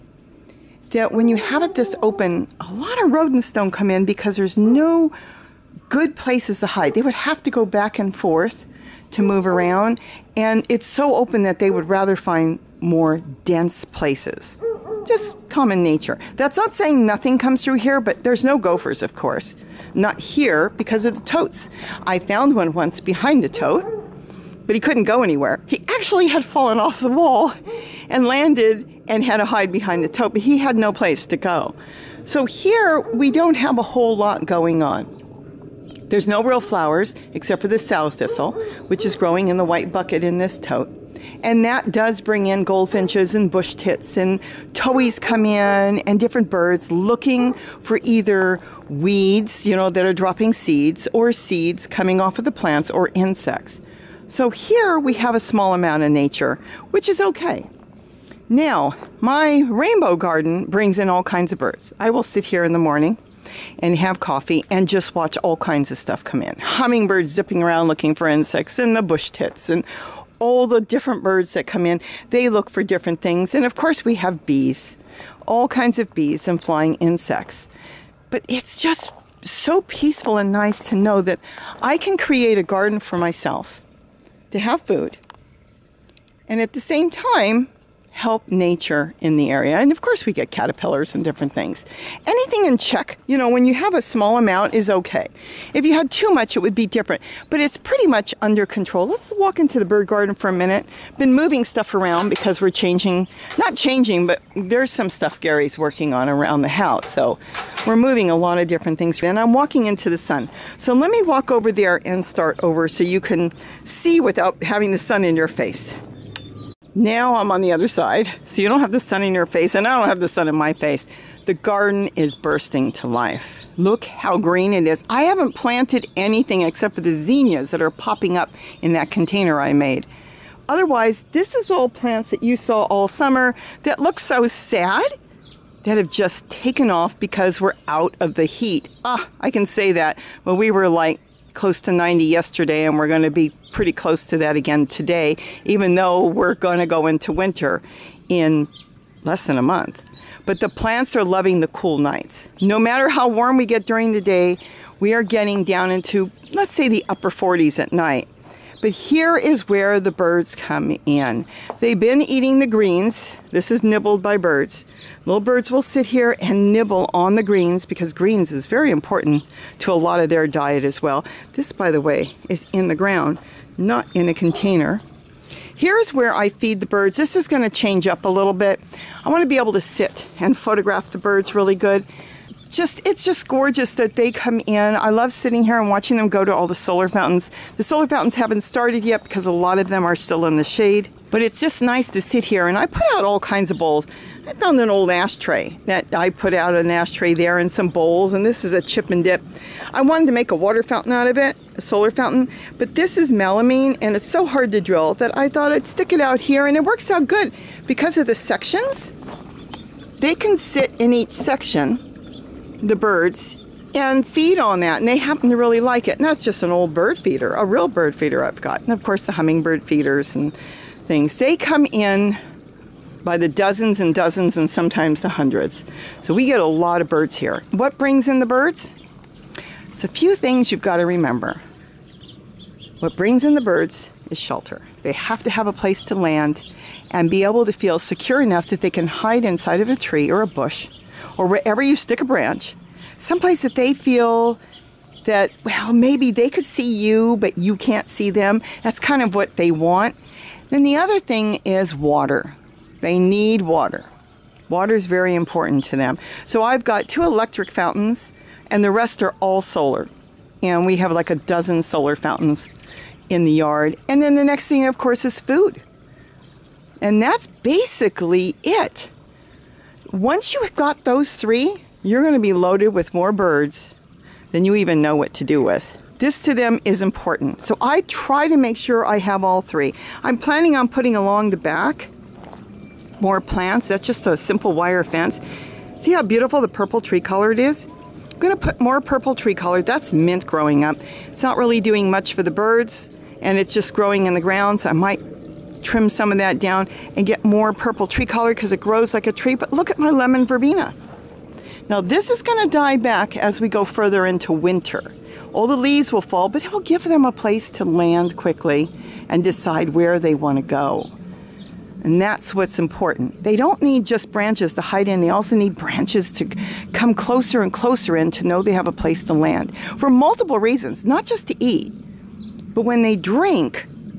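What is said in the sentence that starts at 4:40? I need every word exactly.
I'm planning on putting along the back more plants.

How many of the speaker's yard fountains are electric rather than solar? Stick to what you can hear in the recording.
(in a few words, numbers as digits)
2.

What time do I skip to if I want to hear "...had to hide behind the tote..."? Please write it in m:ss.
0:29.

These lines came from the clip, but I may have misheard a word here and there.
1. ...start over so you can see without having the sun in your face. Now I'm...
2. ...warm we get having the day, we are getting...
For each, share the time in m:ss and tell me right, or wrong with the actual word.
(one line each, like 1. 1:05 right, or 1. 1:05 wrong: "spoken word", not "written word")
1. 1:52 right
2. 2:33 wrong: "during", not "having".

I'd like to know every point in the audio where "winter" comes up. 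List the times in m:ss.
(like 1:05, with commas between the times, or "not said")
2:27, 5:04.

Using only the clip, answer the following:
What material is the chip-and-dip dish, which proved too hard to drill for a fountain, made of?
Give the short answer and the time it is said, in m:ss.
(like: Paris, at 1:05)
melamine, at 3:23.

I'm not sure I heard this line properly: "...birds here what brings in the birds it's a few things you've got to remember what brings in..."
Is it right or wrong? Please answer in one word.
right.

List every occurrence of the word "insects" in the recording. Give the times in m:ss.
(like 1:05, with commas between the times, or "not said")
0:53, 1:08, 1:16.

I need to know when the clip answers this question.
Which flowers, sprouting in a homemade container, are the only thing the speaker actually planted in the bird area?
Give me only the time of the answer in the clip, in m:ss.
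2:07.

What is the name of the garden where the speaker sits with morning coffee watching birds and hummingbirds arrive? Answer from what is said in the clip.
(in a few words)
rainbow garden.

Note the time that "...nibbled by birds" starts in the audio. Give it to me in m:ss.
2:43.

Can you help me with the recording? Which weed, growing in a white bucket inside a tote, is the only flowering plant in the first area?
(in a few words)
sow thistle.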